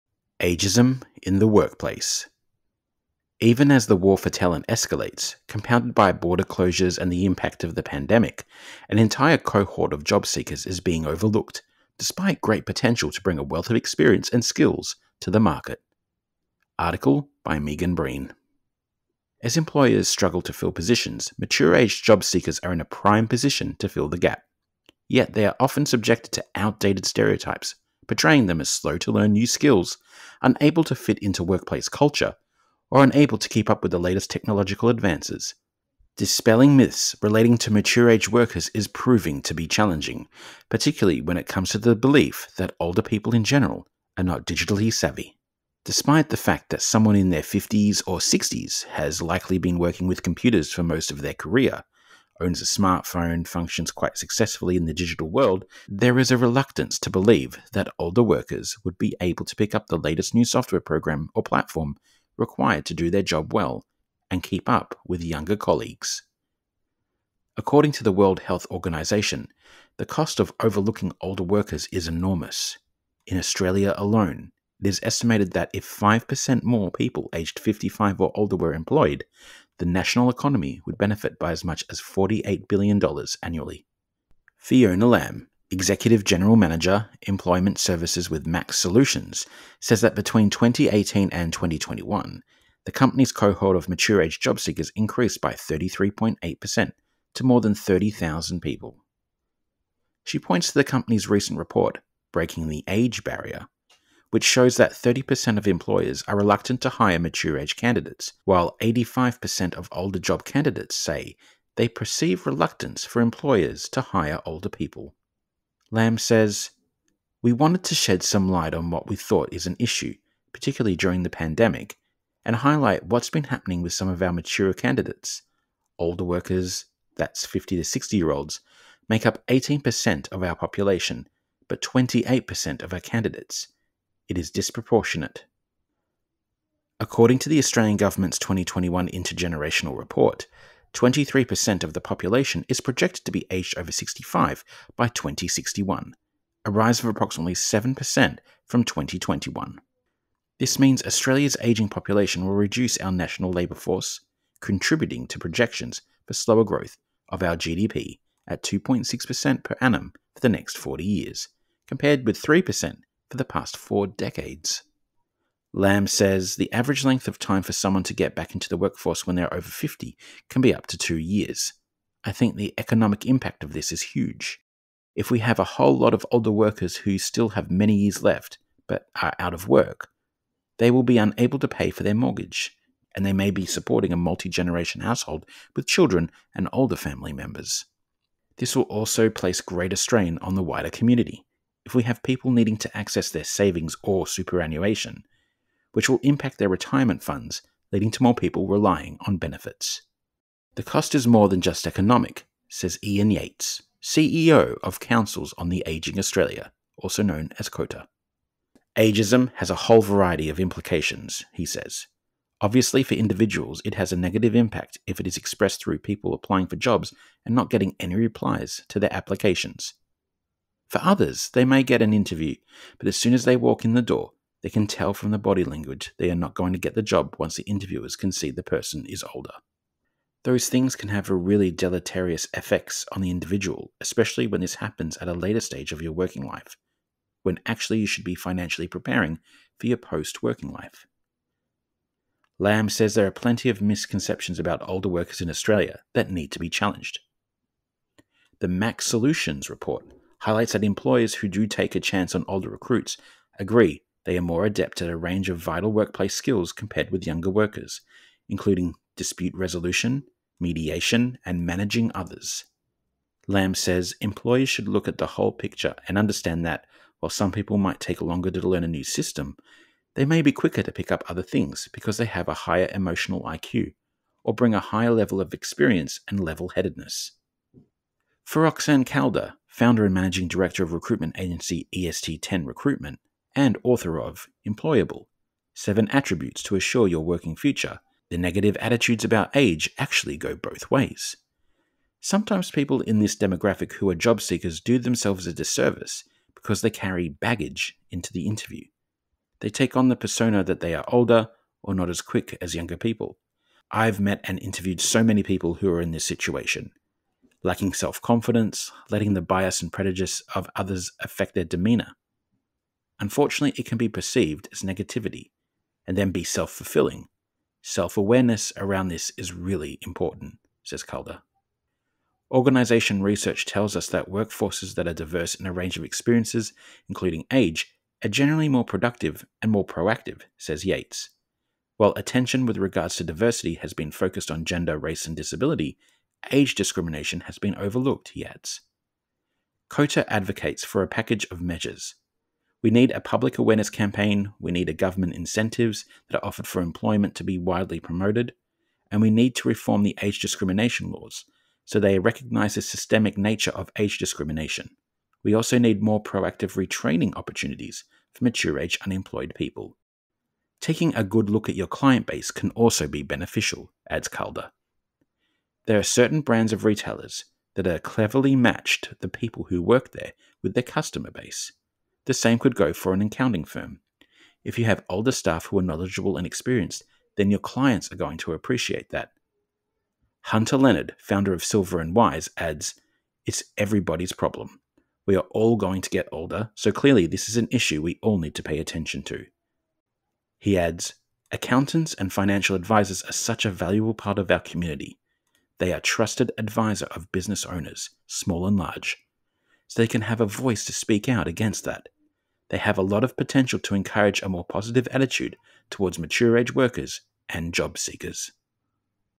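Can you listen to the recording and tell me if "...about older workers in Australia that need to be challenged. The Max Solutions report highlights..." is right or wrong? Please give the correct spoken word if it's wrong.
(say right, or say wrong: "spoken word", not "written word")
right.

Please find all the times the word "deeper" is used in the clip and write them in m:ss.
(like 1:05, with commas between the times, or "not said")
not said.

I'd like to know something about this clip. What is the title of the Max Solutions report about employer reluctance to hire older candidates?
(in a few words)
Breaking the Age Barrier.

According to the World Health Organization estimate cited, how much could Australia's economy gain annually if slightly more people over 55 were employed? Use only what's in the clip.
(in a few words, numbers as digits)
$48 billion.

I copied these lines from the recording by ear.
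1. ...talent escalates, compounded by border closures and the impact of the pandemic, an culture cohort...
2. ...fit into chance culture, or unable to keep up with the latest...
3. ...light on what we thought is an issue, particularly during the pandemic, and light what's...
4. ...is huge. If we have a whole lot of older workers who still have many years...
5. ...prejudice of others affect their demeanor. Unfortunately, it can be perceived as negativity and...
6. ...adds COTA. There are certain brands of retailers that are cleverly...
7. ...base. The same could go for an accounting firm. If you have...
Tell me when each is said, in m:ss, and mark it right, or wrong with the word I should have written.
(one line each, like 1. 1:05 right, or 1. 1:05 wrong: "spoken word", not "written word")
1. 0:04 wrong: "entire", not "culture"
2. 0:30 wrong: "workplace", not "chance"
3. 1:58 wrong: "highlight", not "light"
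4. 2:53 right
5. 5:09 right
6. 6:04 wrong: "Calder", not "COTA"
7. 6:11 right.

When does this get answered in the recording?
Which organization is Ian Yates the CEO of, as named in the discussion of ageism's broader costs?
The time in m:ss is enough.
3:25.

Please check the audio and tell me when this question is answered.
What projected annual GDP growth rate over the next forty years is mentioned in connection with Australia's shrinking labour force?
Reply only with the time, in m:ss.
2:38.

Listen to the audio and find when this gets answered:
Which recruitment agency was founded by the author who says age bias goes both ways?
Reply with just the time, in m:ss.
4:41.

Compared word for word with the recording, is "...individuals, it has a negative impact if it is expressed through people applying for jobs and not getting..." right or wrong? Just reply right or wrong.
right.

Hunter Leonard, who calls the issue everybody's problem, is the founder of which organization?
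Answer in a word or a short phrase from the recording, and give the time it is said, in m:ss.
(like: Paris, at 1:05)
Silver and Wise, at 6:21.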